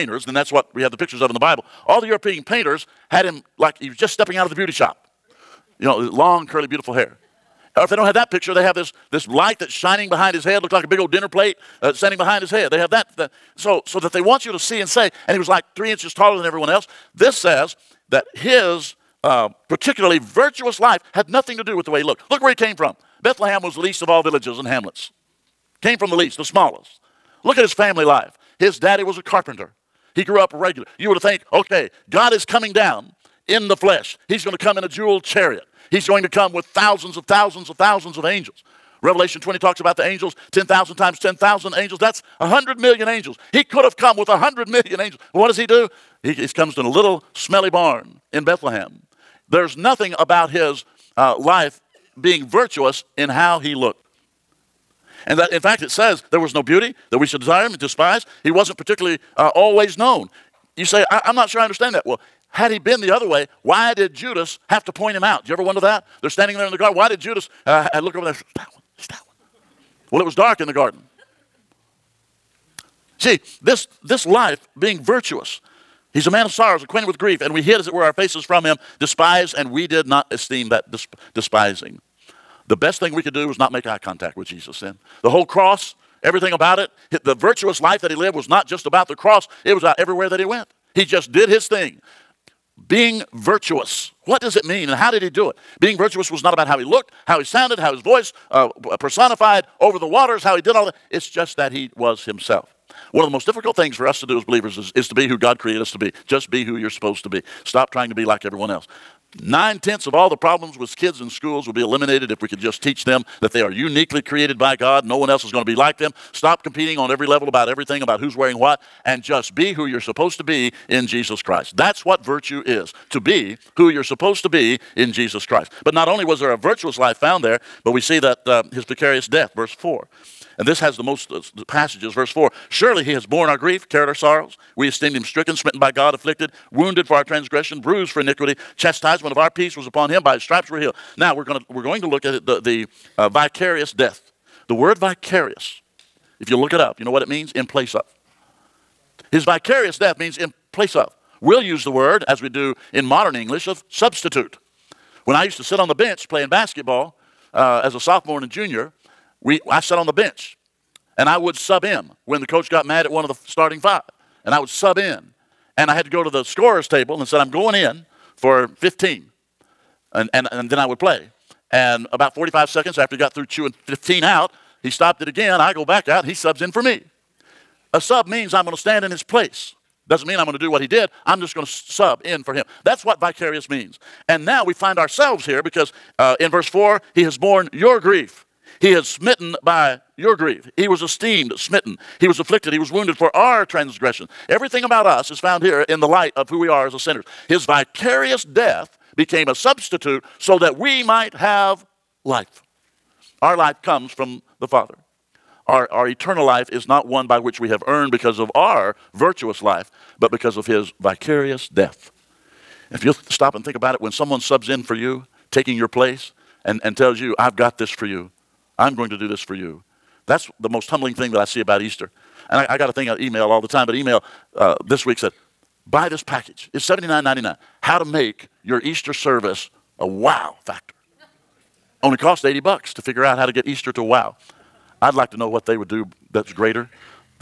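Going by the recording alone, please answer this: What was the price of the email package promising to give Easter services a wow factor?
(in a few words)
$79.99.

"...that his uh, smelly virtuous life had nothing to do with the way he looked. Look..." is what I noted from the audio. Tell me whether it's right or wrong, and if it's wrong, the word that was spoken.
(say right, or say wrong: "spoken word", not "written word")
wrong: "particularly", not "smelly".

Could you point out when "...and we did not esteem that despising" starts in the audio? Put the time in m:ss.
1:19.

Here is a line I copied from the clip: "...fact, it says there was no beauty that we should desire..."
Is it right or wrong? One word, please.
right.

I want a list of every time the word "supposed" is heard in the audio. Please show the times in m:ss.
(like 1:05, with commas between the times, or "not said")
1:46, 2:00, 2:04.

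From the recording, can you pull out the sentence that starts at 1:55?
No one else is going to be like them.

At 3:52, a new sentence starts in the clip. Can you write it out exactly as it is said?
Only cost 80 bucks to figure out how to get Easter to wow.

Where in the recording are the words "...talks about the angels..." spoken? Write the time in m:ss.
0:39.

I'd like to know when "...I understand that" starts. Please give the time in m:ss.
1:01.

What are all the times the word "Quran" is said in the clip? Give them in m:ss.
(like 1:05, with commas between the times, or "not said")
not said.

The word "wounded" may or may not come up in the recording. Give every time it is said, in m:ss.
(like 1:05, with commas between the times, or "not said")
2:16, 3:12.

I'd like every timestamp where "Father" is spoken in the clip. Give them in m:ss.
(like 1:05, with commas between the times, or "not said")
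3:24.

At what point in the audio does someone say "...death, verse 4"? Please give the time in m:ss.
2:09.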